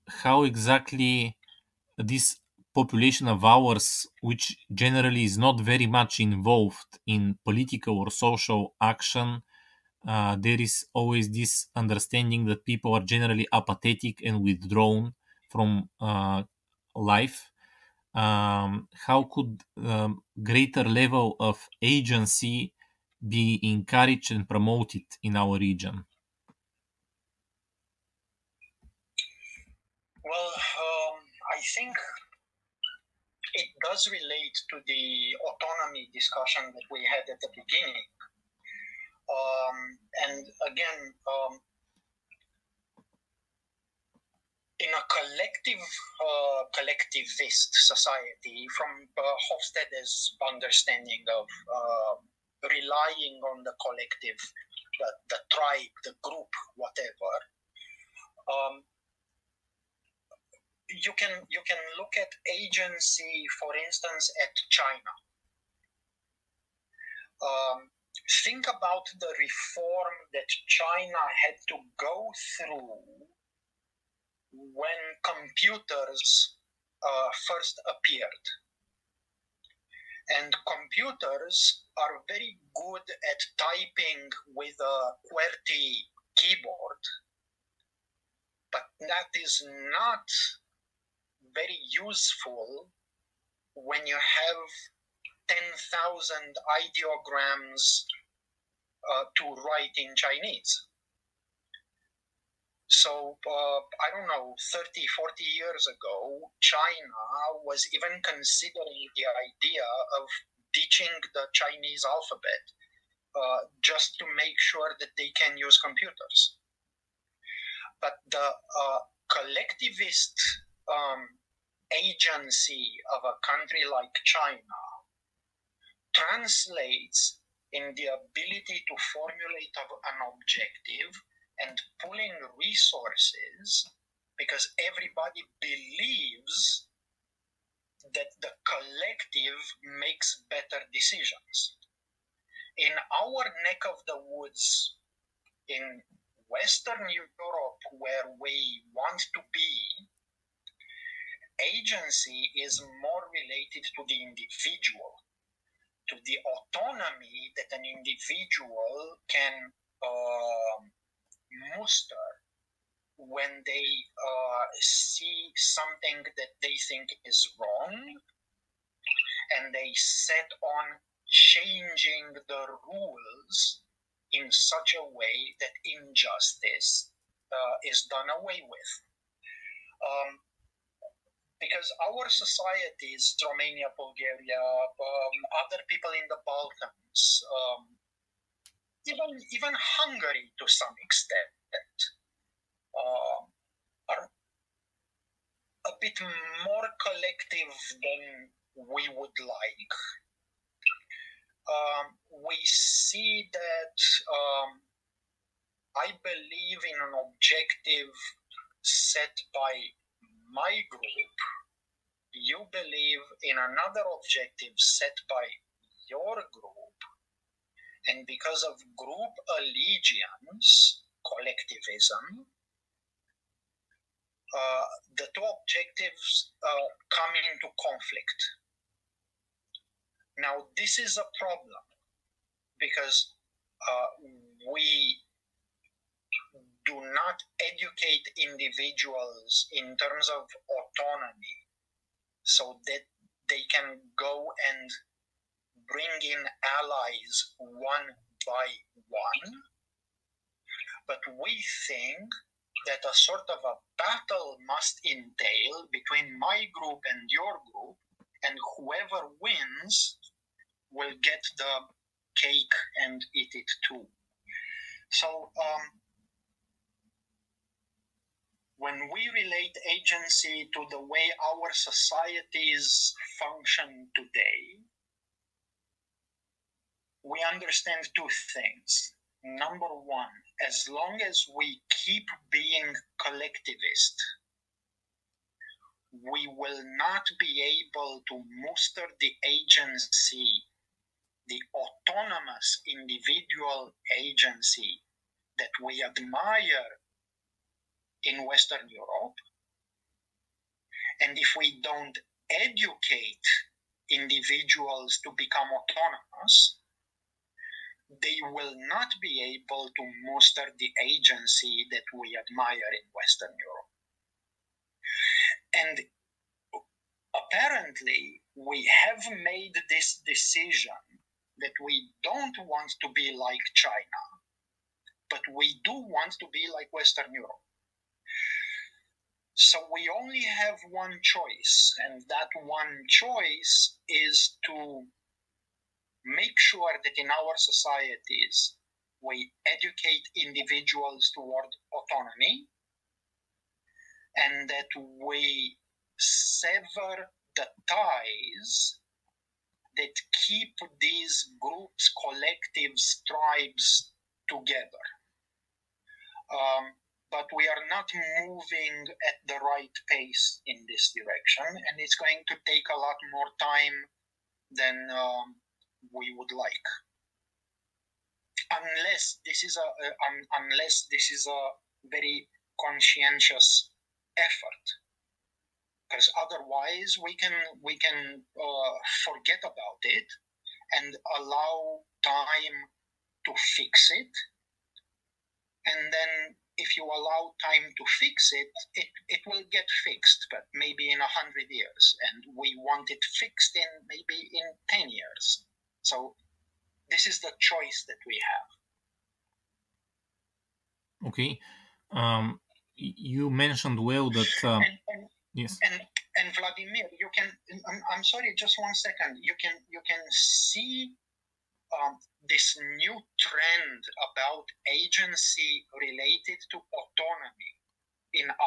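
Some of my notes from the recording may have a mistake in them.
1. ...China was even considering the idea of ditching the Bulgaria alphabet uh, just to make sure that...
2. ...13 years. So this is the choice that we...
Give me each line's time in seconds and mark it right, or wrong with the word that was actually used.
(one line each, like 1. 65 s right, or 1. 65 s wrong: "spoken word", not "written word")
1. 106 s wrong: "Chinese", not "Bulgaria"
2. 394 s wrong: "10", not "13".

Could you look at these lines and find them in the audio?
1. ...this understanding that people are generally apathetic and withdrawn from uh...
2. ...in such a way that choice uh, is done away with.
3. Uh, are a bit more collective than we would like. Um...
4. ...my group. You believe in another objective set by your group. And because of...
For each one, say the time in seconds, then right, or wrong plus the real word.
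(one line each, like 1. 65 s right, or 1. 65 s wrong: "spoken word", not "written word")
1. 11 s right
2. 174 s wrong: "injustice", not "choice"
3. 192 s right
4. 210 s right.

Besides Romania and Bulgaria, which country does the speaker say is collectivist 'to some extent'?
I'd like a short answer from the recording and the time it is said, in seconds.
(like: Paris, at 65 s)
Hungary, at 189 s.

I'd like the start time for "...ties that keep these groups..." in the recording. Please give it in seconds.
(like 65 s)
347 s.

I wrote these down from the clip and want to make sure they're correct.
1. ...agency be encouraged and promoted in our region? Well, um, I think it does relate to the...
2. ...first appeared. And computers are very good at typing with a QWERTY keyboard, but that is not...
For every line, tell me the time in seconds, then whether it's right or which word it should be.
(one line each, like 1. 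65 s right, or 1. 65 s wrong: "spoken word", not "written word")
1. 21 s right
2. 77 s right.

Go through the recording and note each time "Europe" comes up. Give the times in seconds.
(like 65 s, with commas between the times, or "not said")
147 s, 298 s, 313 s, 327 s.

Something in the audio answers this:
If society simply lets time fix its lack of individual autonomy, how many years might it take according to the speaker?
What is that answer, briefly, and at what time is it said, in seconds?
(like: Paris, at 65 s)
100 years, at 391 s.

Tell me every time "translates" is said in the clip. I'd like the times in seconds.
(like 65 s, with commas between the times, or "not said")
126 s.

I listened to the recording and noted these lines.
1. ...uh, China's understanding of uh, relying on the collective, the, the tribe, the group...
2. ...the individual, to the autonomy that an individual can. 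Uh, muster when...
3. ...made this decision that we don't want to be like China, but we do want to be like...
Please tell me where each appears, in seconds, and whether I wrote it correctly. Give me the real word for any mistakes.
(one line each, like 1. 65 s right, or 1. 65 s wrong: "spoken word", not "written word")
1. 49 s wrong: "Hofstede", not "China"
2. 154 s right
3. 319 s right.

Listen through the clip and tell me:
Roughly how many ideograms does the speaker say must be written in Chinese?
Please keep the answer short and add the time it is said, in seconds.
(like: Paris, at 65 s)
10,000, at 95 s.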